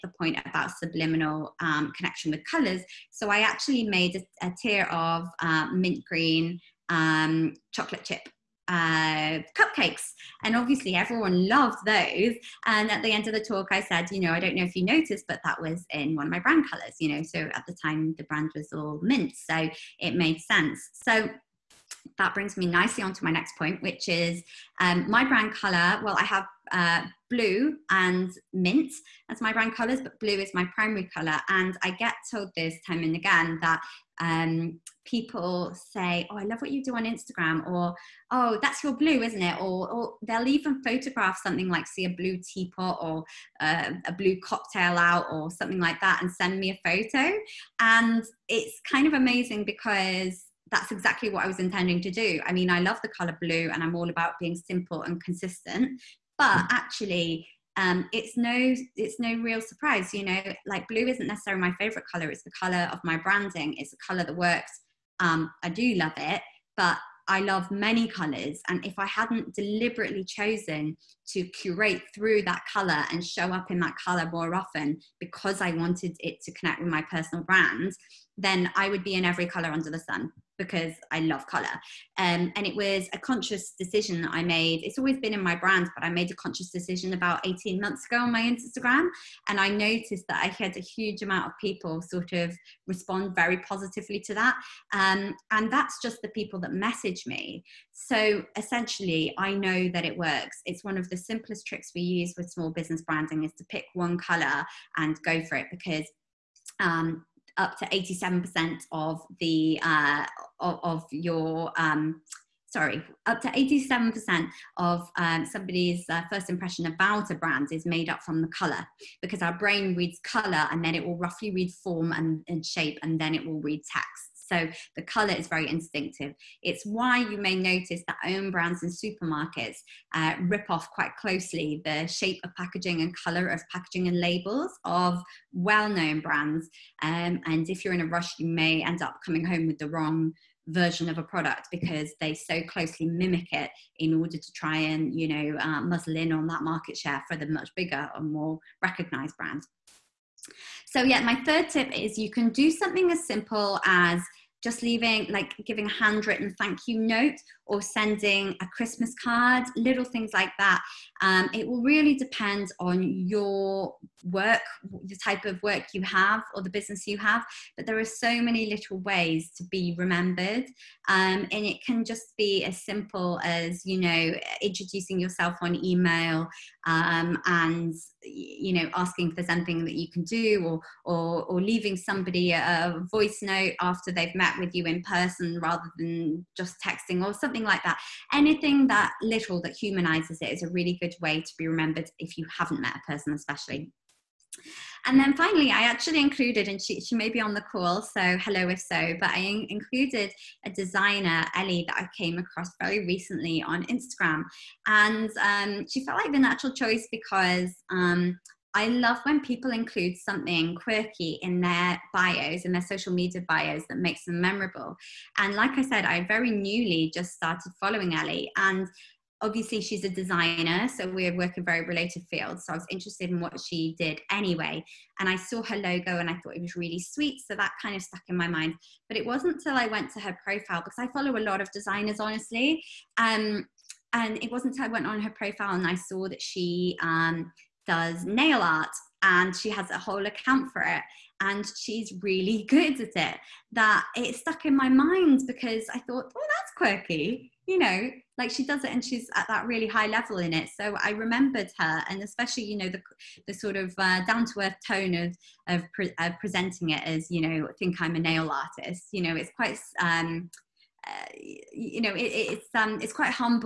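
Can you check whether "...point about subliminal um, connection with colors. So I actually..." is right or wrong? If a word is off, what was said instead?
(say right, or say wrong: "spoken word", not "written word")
right.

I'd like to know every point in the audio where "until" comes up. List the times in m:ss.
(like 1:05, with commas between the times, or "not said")
3:49, 3:54.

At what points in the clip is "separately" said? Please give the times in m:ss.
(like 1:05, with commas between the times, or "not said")
not said.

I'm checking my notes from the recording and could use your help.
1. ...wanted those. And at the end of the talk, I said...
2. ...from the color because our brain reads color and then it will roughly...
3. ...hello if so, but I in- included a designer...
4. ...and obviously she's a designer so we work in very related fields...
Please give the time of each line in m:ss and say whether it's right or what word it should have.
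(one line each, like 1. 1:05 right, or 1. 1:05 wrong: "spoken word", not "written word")
1. 0:11 wrong: "loved", not "wanted"
2. 1:58 right
3. 3:18 right
4. 3:38 right.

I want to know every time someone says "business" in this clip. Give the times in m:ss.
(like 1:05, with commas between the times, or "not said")
1:42, 2:46.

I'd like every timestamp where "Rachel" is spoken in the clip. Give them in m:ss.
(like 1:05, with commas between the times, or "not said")
not said.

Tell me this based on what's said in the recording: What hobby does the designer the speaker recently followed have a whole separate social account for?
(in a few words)
nail art.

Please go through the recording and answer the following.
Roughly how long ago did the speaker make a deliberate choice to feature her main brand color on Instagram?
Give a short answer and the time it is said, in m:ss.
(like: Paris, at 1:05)
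18 months, at 1:27.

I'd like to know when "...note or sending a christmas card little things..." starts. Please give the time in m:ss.
2:36.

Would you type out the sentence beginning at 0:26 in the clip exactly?
Well, I have uh, blue and mint as my brand colors, but blue is my primary color.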